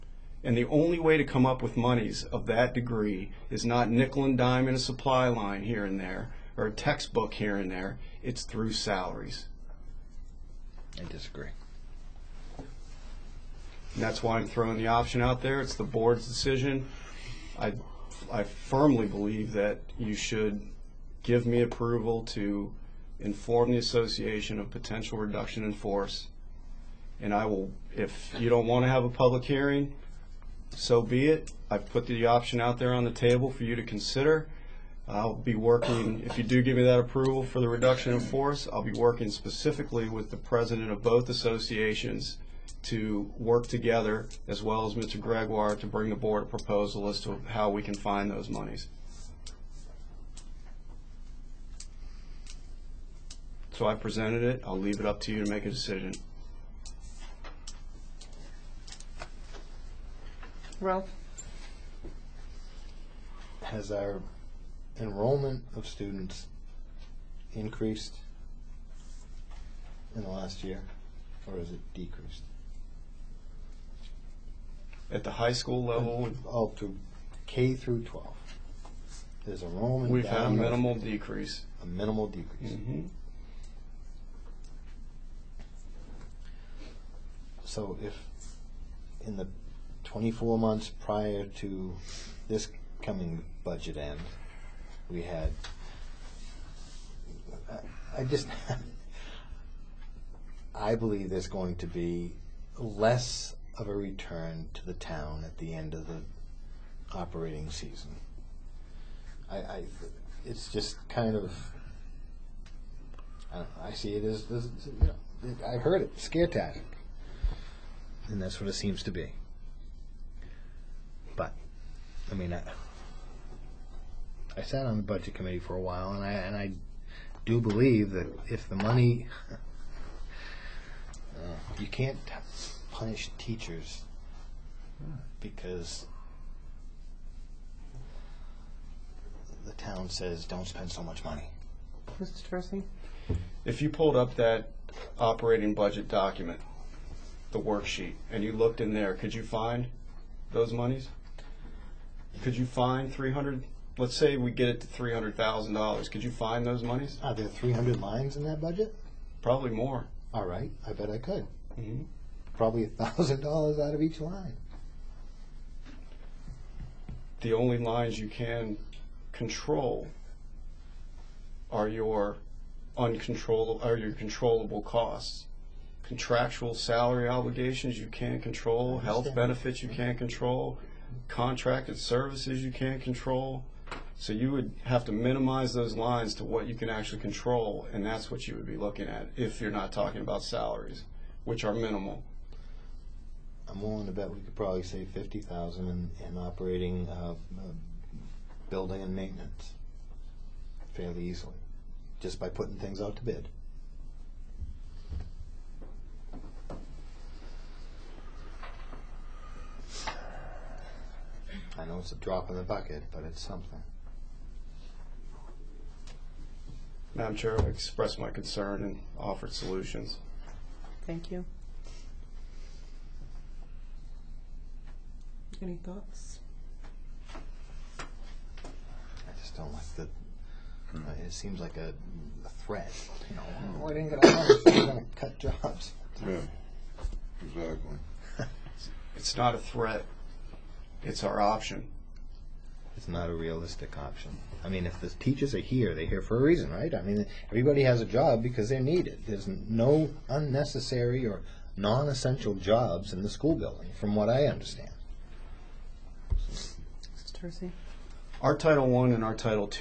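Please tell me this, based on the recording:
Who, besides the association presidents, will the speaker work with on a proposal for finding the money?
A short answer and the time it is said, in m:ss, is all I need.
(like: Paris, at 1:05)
Mr. Gregoire, at 0:44.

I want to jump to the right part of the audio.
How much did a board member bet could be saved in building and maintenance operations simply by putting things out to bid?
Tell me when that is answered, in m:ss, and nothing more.
3:15.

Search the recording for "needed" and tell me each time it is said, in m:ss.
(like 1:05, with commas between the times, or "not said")
4:08.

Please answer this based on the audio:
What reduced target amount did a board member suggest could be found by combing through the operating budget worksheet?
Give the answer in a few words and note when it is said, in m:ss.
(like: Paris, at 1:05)
$300,000, at 2:34.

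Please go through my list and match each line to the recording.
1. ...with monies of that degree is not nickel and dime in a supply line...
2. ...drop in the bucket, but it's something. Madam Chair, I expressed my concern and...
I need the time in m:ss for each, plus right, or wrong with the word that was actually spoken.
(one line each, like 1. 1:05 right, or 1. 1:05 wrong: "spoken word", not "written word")
1. 0:01 right
2. 3:32 right.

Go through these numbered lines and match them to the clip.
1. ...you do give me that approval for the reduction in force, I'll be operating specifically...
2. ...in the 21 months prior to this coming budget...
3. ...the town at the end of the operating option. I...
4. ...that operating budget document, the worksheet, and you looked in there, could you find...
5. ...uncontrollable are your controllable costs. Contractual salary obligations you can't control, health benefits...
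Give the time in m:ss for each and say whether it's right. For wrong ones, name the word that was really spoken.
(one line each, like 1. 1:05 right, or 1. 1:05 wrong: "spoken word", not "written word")
1. 0:36 wrong: "working", not "operating"
2. 1:29 wrong: "24", not "21"
3. 1:44 wrong: "season", not "option"
4. 2:24 right
5. 2:52 right.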